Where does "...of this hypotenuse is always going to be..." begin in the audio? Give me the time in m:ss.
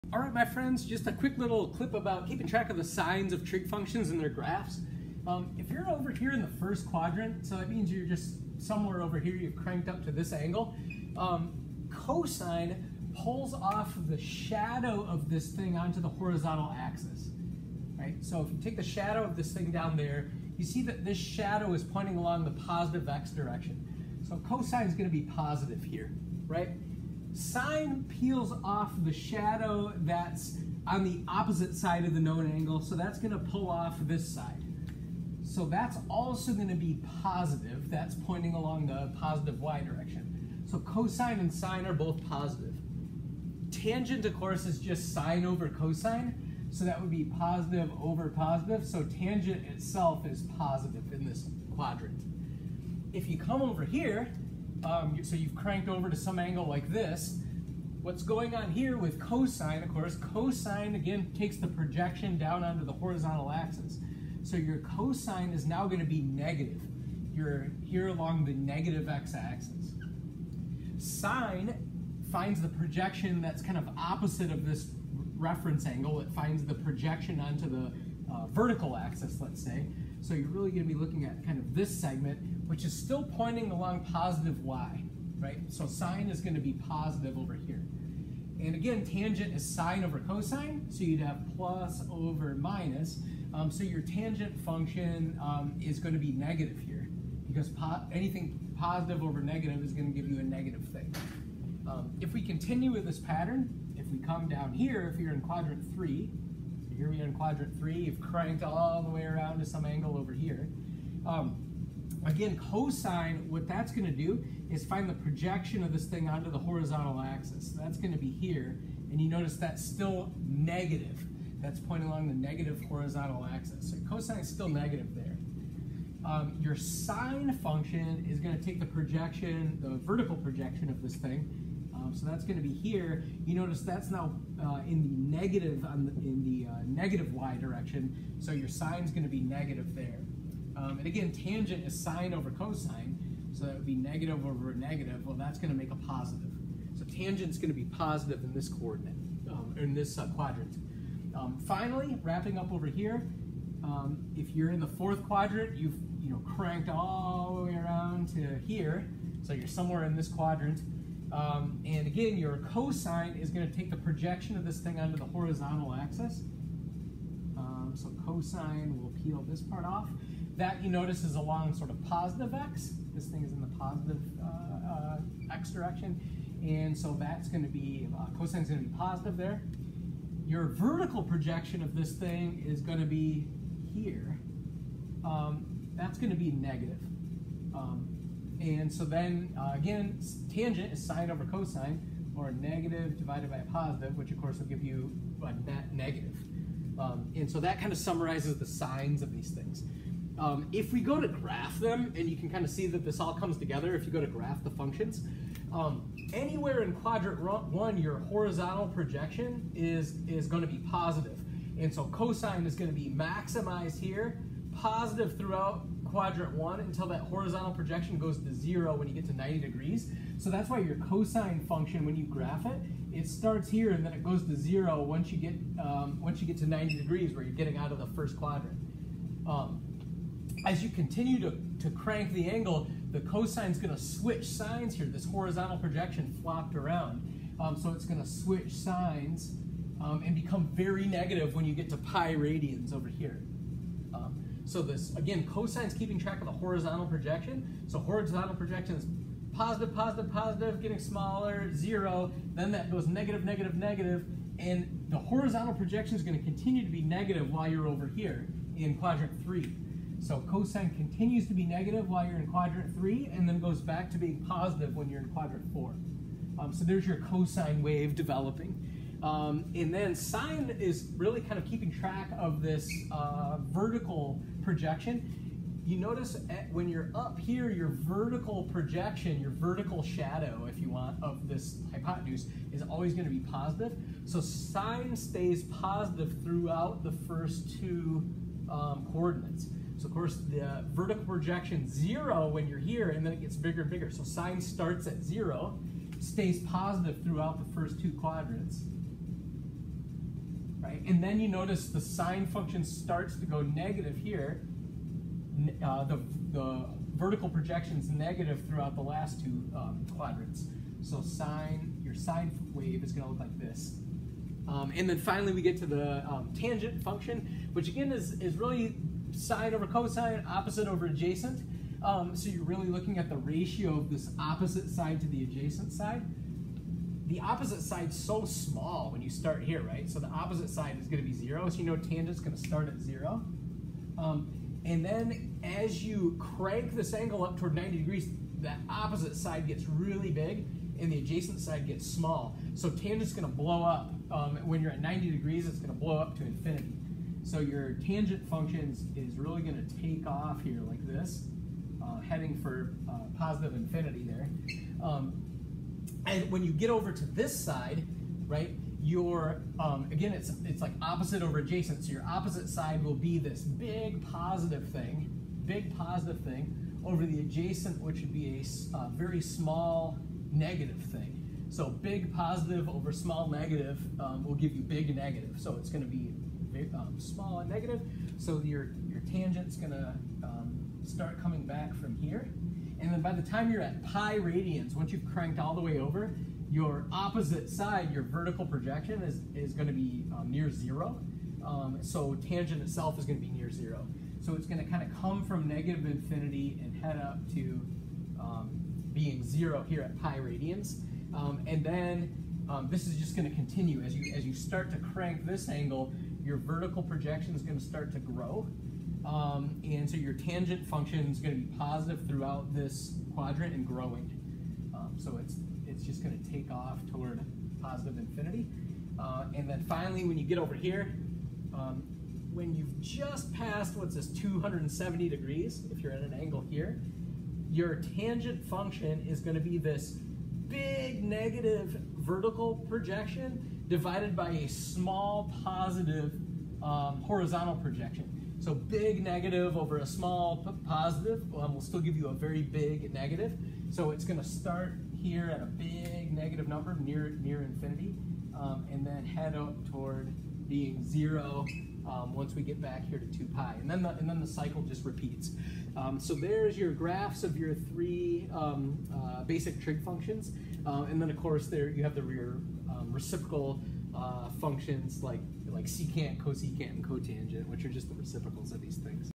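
4:41.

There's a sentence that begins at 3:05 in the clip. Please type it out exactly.
Um, that's going to be negative.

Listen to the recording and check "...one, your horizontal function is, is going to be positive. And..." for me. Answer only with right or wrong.
wrong.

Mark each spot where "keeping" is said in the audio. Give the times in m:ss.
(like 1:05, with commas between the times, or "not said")
0:02, 4:05, 4:31.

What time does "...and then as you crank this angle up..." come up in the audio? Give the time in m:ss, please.
5:34.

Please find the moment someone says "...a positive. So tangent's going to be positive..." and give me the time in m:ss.
2:25.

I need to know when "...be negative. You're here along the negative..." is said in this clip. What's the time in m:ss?
1:06.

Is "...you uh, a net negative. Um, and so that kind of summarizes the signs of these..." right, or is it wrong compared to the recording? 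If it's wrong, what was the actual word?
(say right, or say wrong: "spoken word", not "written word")
right.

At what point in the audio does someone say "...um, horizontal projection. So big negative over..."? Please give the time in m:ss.
7:16.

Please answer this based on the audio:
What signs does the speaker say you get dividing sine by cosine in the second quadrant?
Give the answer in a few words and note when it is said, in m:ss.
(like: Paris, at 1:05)
plus over minus, at 1:31.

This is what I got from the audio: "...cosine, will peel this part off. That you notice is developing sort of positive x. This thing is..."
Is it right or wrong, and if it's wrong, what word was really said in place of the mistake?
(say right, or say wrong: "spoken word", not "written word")
wrong: "along", not "developing".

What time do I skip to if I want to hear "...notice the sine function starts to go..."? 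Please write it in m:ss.
5:01.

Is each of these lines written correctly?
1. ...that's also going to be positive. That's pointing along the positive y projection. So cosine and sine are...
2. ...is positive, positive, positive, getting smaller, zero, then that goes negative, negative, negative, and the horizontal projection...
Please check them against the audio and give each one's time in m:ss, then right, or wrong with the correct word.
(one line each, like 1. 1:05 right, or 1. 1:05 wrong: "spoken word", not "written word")
1. 0:35 wrong: "direction", not "projection"
2. 4:08 right.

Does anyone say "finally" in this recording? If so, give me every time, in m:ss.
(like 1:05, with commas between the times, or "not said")
2:31, 5:15, 6:59.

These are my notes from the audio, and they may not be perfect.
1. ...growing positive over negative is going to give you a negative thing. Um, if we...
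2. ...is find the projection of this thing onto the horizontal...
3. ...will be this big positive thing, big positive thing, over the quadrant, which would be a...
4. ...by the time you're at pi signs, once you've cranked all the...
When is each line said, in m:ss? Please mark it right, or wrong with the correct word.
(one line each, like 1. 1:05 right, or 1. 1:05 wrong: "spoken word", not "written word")
1. 1:38 wrong: "anything", not "growing"
2. 1:54 right
3. 6:03 wrong: "adjacent", not "quadrant"
4. 6:23 wrong: "radians", not "signs".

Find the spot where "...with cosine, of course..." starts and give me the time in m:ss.
0:58.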